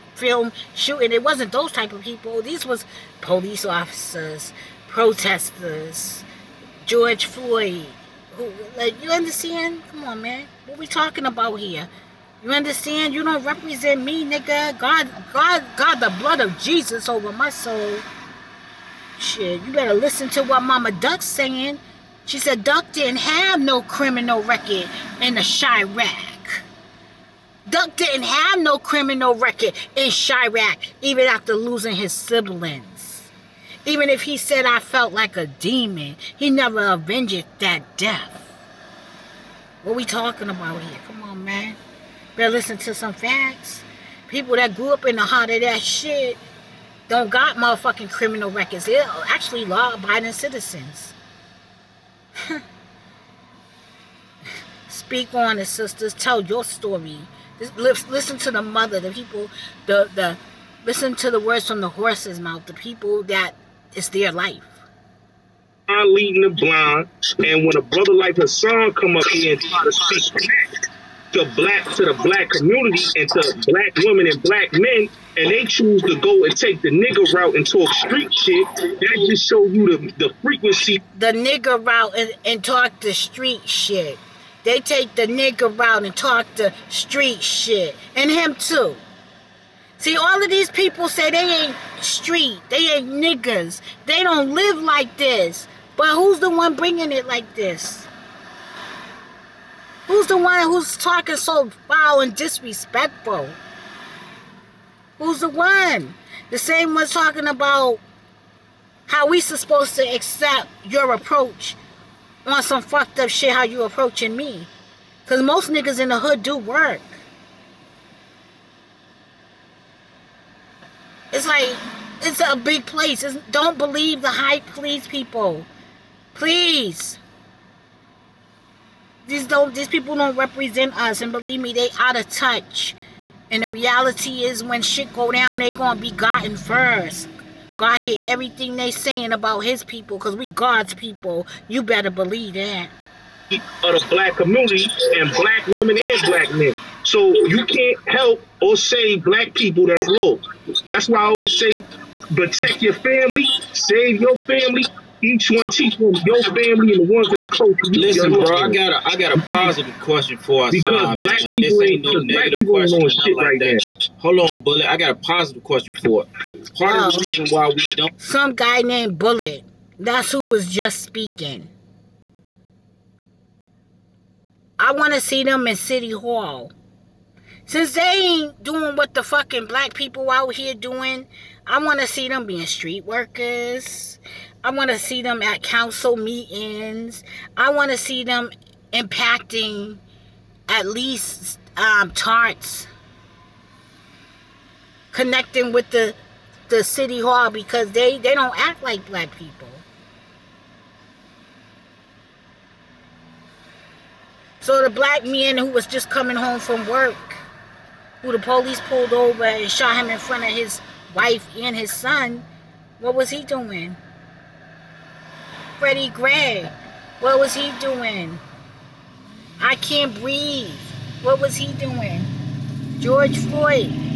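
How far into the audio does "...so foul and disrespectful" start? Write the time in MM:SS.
01:41.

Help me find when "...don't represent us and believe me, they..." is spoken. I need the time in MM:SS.
02:10.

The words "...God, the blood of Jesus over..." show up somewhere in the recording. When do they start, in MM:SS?
00:15.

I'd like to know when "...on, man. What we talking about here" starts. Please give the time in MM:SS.
00:10.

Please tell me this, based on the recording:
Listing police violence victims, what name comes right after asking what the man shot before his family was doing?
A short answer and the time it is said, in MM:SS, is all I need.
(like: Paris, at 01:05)
Freddie Gray, at 03:35.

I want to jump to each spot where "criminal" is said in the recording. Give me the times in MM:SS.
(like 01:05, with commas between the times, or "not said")
00:23, 00:28, 00:48.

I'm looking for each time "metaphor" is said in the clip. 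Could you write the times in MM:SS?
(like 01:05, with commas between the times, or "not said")
not said.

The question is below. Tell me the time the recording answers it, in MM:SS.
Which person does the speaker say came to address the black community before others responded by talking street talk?
01:08.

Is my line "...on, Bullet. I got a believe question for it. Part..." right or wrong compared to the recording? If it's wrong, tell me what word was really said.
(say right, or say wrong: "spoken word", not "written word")
wrong: "positive", not "believe".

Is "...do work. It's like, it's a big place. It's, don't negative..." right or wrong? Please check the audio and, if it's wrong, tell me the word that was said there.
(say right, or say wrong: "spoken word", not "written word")
wrong: "believe", not "negative".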